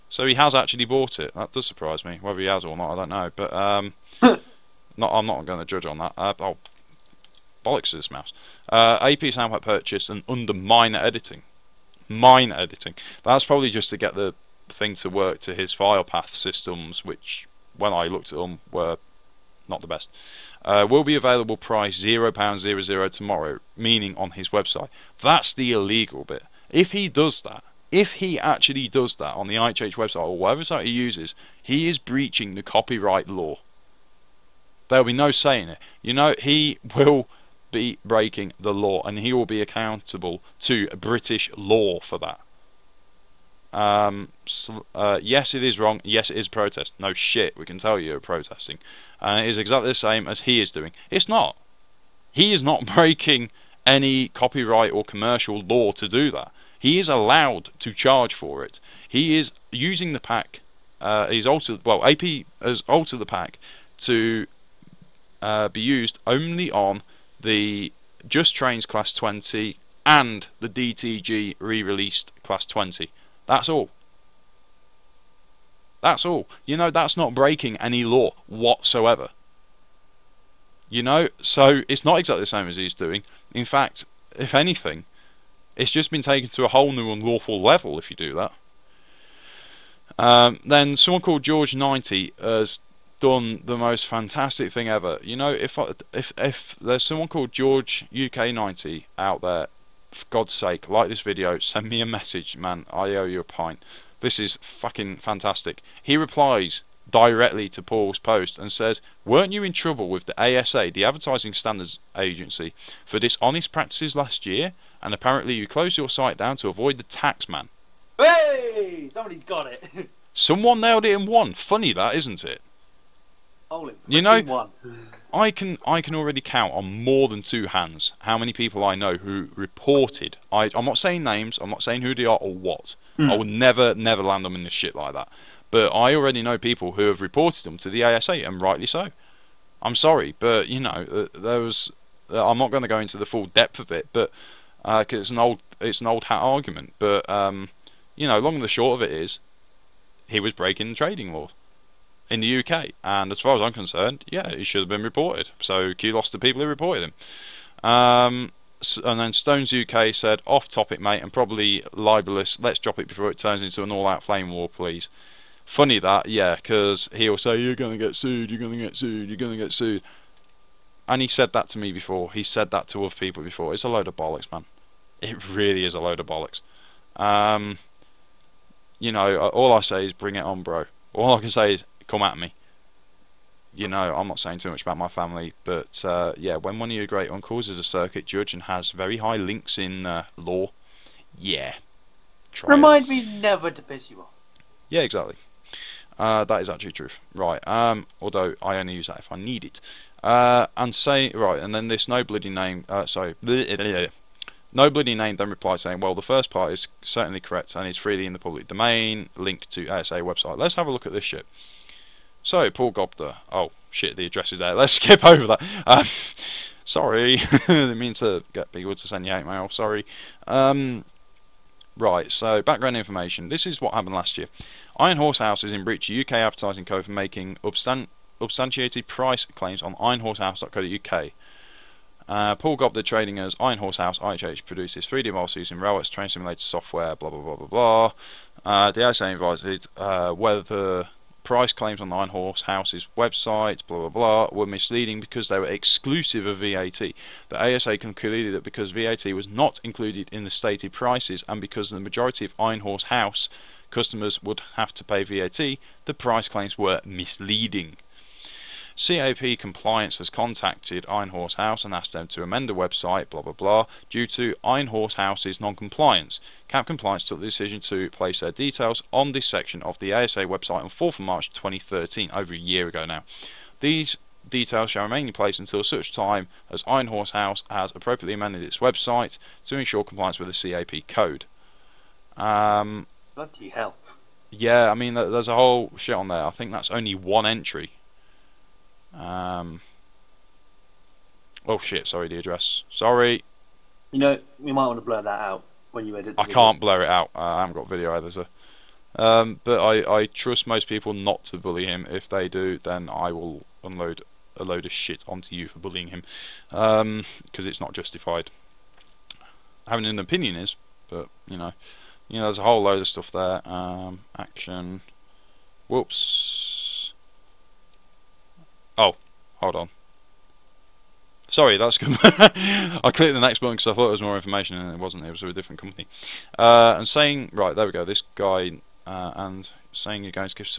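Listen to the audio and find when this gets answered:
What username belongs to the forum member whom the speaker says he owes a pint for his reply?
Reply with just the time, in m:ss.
1:37.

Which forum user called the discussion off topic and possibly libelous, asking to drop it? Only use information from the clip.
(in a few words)
Stones UK.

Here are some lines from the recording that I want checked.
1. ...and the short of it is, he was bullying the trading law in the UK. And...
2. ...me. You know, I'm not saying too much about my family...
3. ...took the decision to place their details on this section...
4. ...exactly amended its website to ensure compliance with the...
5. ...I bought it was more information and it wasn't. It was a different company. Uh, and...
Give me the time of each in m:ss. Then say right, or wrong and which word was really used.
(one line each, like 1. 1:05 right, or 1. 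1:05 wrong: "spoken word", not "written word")
1. 2:28 wrong: "breaking", not "bullying"
2. 3:02 right
3. 4:27 right
4. 4:37 wrong: "appropriately", not "exactly"
5. 5:23 wrong: "thought", not "bought".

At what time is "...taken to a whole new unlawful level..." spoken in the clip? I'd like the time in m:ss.
1:26.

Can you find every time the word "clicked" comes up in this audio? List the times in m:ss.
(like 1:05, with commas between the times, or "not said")
5:23.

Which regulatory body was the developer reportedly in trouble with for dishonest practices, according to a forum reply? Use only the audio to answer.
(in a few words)
Advertising Standards Agency.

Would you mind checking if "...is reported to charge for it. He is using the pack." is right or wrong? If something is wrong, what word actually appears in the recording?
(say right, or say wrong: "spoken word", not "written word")
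wrong: "allowed", not "reported".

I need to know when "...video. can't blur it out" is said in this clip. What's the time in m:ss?
4:56.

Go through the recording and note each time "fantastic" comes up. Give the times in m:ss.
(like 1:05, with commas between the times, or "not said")
1:34, 1:45.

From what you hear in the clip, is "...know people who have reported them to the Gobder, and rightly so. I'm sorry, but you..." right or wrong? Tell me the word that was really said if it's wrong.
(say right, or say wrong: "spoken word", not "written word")
wrong: "ASA", not "Gobder".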